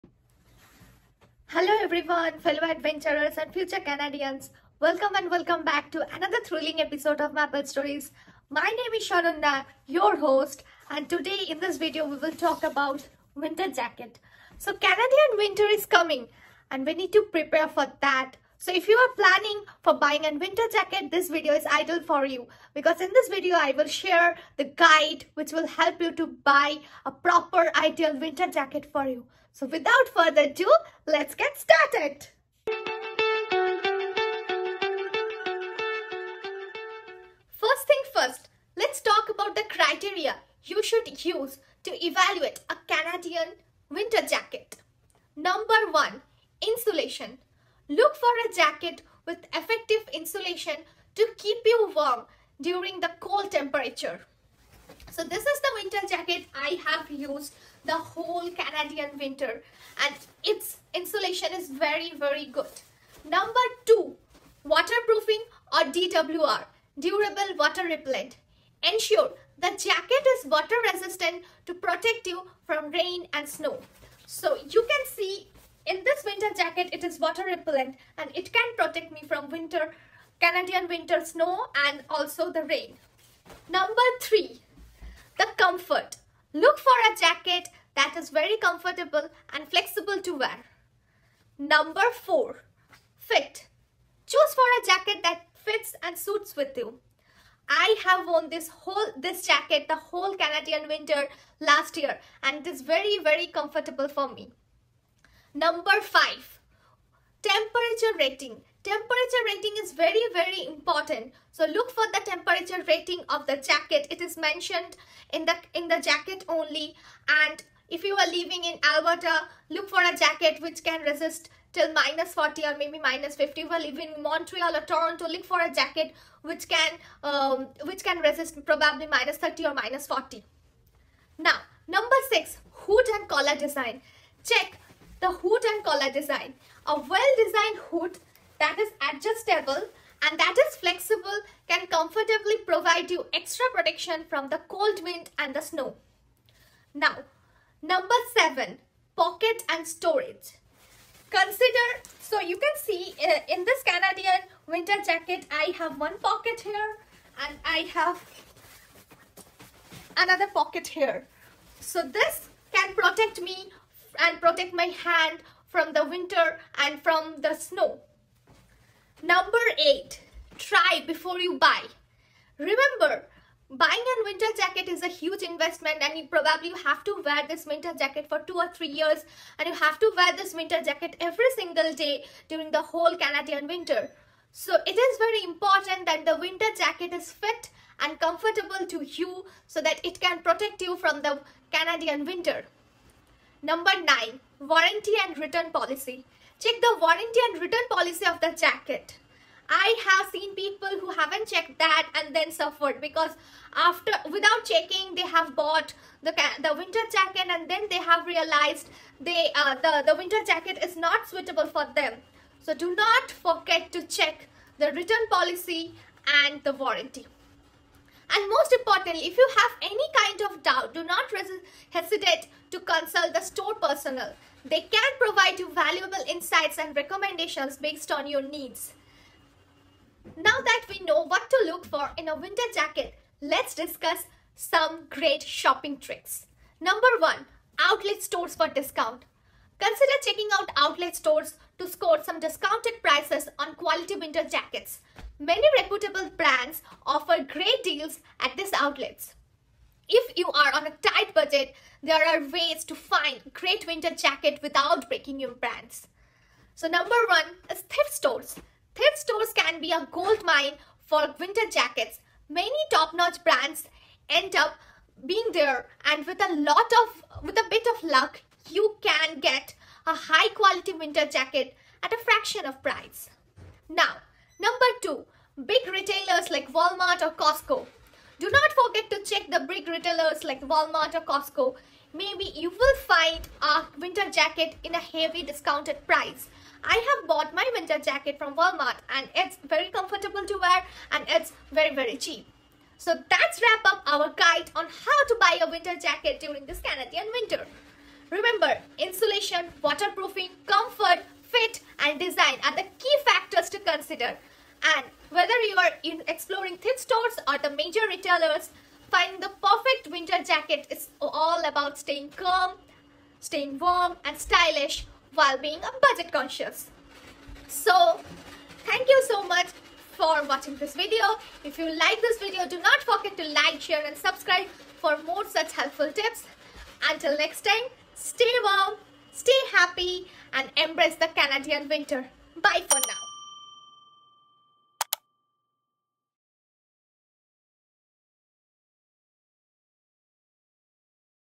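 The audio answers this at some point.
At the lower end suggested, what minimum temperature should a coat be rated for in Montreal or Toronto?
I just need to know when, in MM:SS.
02:09.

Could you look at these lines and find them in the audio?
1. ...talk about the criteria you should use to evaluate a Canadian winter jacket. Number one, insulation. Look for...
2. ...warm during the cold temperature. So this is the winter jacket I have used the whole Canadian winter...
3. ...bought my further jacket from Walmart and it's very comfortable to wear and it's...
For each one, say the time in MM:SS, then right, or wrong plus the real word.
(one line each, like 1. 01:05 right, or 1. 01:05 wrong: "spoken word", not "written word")
1. 00:39 right
2. 00:51 right
3. 04:47 wrong: "winter", not "further".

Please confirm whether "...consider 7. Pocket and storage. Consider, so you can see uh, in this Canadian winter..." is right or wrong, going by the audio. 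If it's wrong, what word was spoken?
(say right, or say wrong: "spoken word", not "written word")
wrong: "number", not "consider".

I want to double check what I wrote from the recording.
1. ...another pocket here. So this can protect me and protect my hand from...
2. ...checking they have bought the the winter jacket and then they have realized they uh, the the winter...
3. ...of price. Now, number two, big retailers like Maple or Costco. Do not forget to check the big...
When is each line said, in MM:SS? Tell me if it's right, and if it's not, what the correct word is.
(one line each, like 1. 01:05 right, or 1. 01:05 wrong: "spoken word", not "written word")
1. 02:40 right
2. 03:24 right
3. 04:32 wrong: "Walmart", not "Maple".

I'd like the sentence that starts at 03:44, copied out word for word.
They can provide you valuable insights and recommendations based on your needs.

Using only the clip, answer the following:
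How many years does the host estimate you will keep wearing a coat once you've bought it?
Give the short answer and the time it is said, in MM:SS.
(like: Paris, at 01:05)
2 or 3 years, at 02:58.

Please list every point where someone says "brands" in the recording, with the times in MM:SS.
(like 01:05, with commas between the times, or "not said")
04:06, 04:15, 04:23.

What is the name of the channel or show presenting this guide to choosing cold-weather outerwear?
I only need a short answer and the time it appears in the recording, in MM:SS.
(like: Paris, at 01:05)
Maple Stories, at 00:07.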